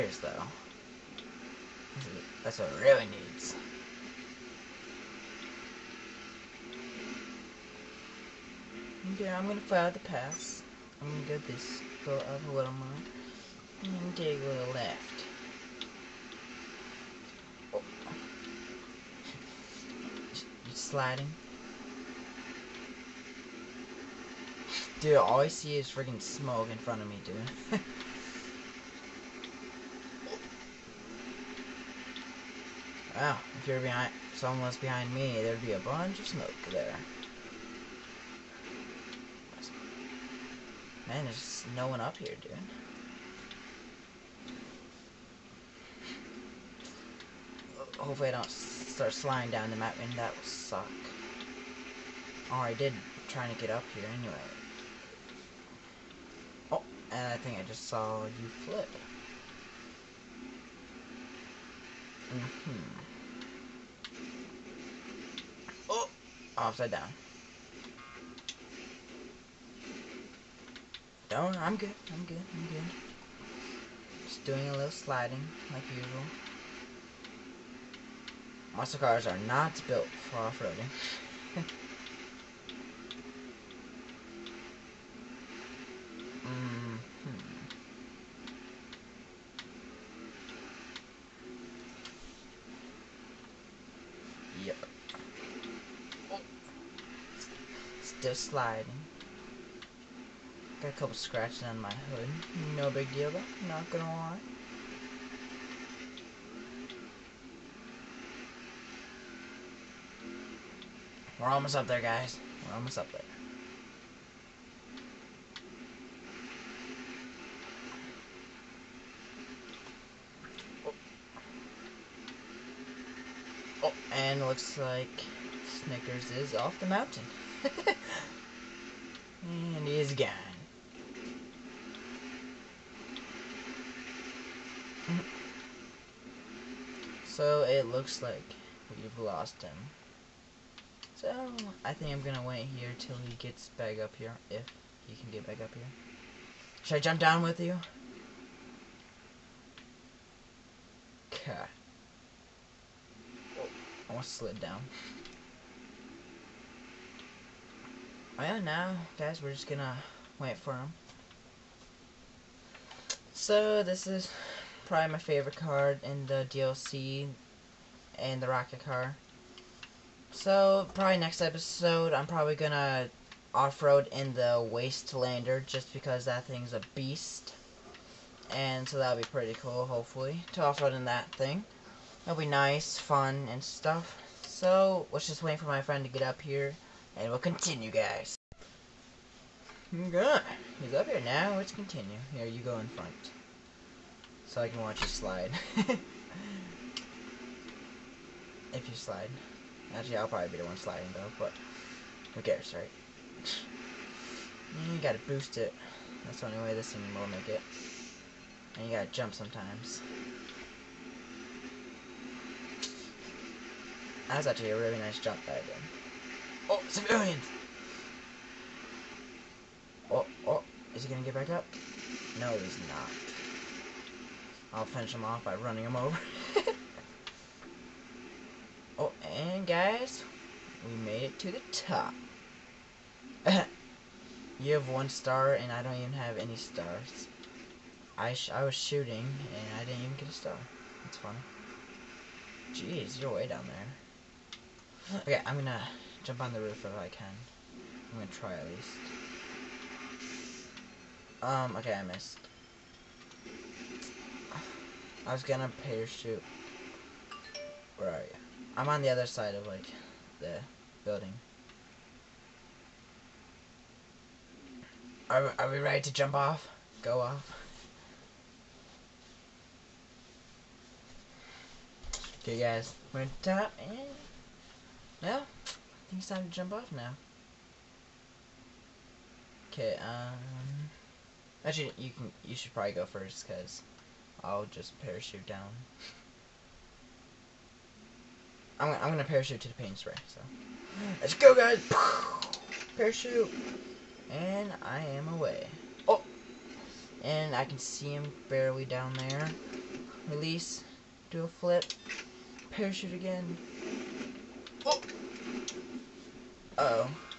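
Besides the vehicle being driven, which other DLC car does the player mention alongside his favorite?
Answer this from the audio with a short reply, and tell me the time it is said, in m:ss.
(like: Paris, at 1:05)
rocket car, at 2:48.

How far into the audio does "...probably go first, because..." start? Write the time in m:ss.
4:42.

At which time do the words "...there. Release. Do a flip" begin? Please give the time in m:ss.
4:59.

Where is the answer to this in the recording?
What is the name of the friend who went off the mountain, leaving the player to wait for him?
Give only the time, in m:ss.
2:05.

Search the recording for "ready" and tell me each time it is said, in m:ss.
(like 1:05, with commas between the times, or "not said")
4:25.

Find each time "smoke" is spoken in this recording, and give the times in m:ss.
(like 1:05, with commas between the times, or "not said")
0:26, 0:36.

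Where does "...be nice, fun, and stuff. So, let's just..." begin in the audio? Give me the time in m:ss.
3:02.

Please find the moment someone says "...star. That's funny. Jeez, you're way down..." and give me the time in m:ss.
4:00.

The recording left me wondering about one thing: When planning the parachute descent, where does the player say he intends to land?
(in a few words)
the paint spray.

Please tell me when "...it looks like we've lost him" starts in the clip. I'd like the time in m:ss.
2:17.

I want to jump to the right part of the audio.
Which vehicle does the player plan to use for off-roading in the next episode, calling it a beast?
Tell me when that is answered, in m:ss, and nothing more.
2:54.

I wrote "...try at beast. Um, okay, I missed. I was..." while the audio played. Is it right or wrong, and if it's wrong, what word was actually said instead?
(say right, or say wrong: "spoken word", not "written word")
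wrong: "least", not "beast".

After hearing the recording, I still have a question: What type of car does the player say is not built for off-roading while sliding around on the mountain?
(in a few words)
Muscle cars.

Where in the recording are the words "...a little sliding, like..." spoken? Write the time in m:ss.
1:14.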